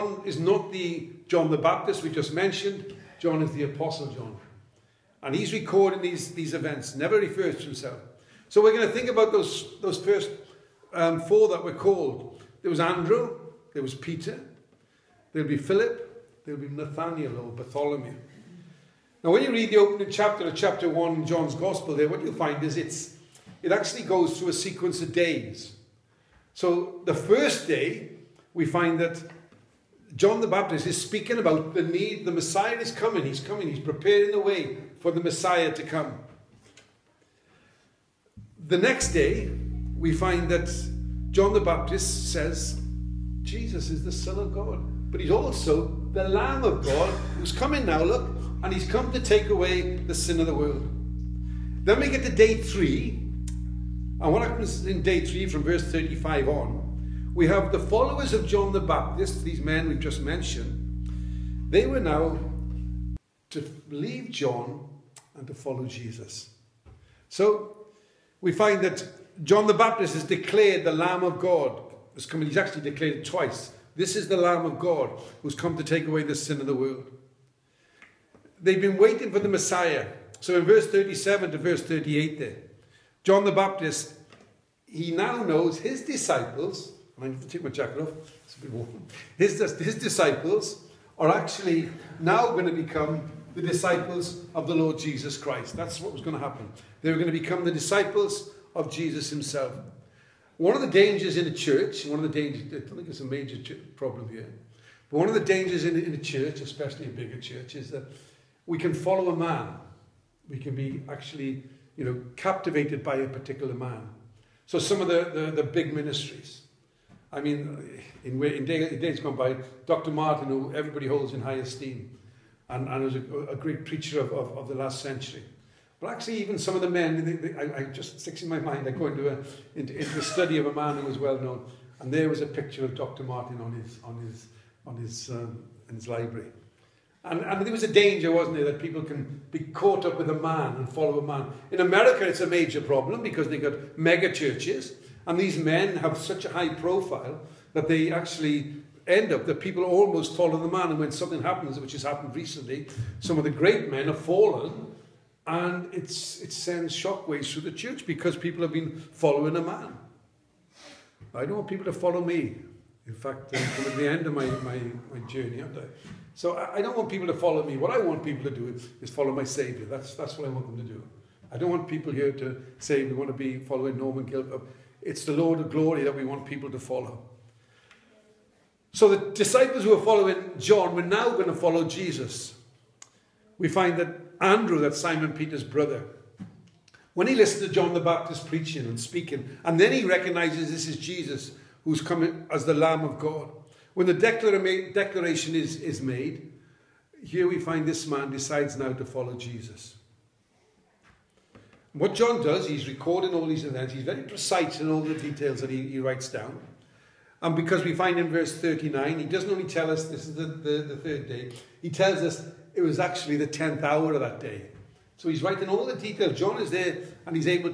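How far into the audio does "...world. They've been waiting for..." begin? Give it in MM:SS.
01:16.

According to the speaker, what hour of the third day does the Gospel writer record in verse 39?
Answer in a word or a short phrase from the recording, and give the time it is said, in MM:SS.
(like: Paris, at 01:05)
10th hour, at 03:33.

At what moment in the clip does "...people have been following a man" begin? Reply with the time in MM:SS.
02:38.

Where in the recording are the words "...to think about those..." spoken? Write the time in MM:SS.
00:08.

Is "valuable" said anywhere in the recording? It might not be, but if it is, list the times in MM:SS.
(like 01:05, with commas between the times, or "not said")
not said.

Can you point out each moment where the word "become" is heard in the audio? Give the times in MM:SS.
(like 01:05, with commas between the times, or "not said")
01:32, 01:37.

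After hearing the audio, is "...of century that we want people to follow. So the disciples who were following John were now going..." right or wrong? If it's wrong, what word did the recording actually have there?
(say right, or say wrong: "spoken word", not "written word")
wrong: "glory", not "century".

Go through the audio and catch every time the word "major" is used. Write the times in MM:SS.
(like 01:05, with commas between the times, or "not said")
01:43, 02:22.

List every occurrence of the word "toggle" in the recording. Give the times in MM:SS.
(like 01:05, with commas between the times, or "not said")
not said.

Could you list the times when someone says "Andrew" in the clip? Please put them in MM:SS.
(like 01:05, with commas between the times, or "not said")
00:12, 03:04.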